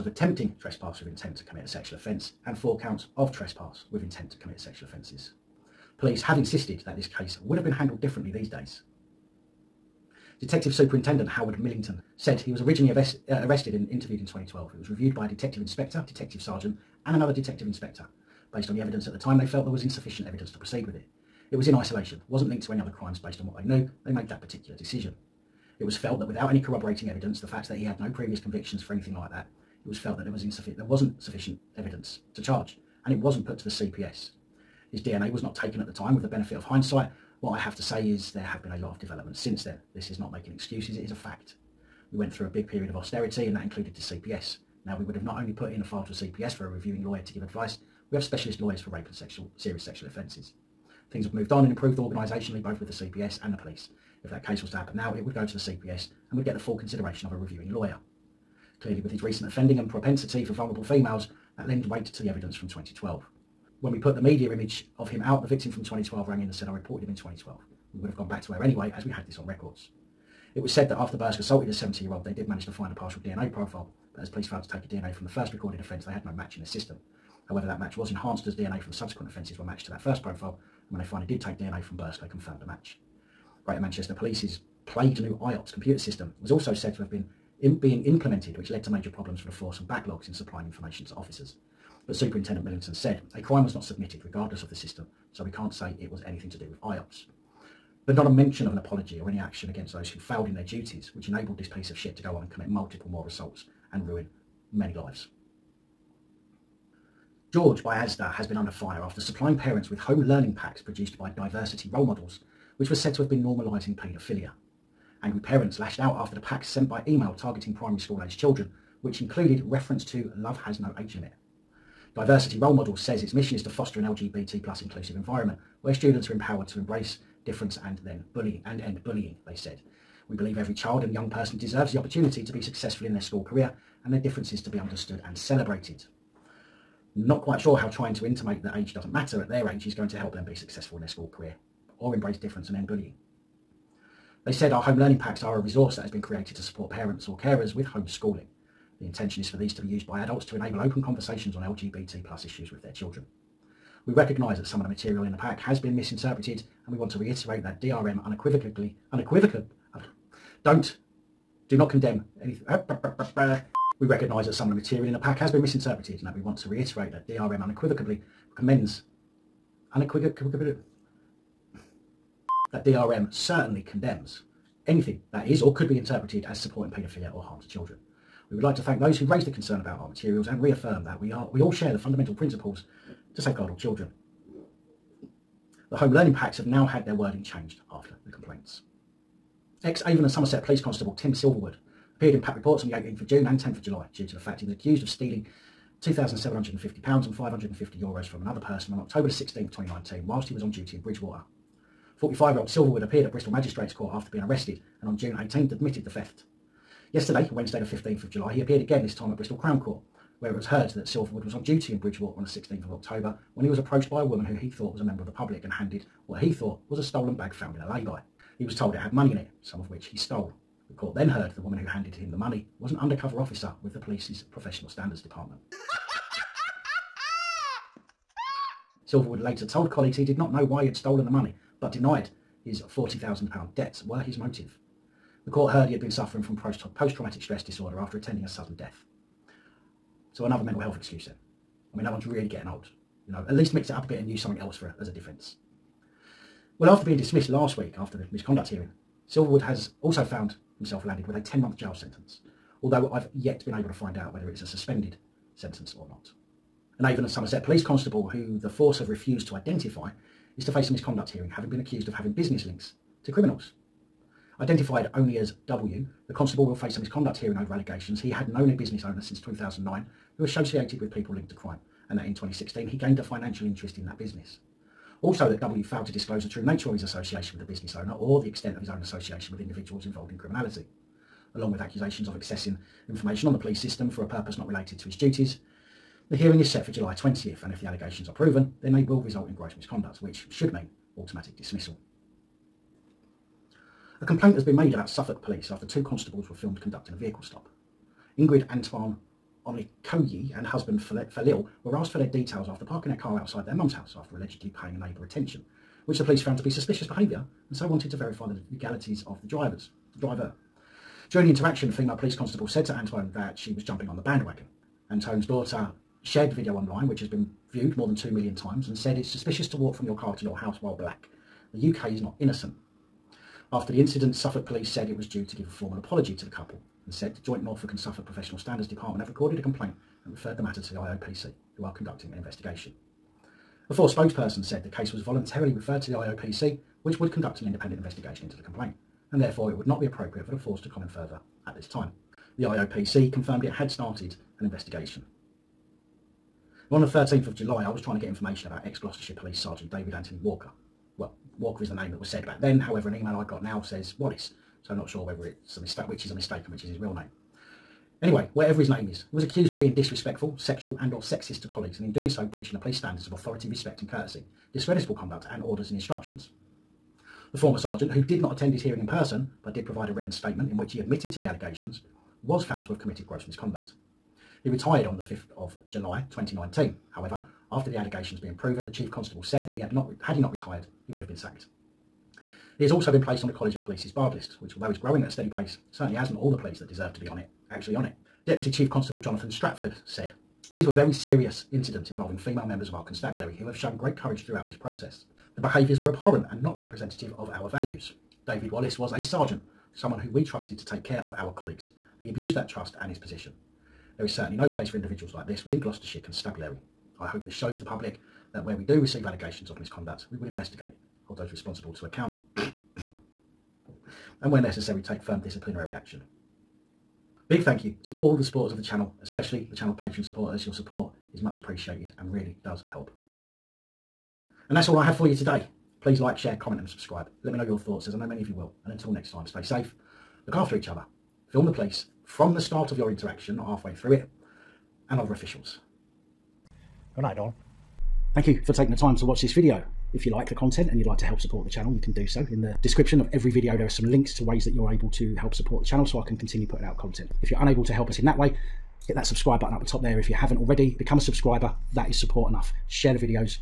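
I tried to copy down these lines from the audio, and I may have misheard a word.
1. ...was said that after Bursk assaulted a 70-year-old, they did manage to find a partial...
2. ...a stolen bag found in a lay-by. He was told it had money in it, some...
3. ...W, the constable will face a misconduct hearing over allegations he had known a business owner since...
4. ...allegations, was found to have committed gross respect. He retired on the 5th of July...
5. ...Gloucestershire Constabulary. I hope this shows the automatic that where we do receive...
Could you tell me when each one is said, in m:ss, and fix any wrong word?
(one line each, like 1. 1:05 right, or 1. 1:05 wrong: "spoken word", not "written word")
1. 1:10 right
2. 3:36 right
3. 4:25 right
4. 6:11 wrong: "misconduct", not "respect"
5. 6:45 wrong: "public", not "automatic".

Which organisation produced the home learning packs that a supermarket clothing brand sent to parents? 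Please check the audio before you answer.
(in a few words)
Diversity Role Models.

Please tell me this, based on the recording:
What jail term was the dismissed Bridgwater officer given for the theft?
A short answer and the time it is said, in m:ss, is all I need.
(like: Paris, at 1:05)
10 months, at 4:11.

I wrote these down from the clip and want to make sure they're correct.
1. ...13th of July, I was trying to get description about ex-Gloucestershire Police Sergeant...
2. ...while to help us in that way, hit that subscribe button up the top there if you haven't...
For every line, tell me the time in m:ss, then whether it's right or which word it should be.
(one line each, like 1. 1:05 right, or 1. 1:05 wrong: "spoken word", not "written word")
1. 5:47 wrong: "information", not "description"
2. 7:27 wrong: "unable", not "while".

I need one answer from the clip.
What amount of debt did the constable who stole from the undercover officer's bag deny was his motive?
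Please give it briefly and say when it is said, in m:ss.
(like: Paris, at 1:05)
£40,000, at 3:52.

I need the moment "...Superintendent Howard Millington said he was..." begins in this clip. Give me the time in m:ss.
0:10.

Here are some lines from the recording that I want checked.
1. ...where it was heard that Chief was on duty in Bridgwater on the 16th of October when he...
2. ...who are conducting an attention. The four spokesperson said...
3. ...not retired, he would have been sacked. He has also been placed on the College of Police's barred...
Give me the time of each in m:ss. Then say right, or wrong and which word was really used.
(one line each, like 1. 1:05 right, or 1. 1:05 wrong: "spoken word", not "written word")
1. 3:30 wrong: "Silverwood", not "Chief"
2. 5:31 wrong: "investigation", not "attention"
3. 6:20 right.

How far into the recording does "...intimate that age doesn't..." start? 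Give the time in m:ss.
2:18.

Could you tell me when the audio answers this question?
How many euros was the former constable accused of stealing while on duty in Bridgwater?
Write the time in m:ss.
3:17.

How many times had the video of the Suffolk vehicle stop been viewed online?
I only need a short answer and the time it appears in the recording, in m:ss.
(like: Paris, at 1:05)
More than 2 million, at 5:17.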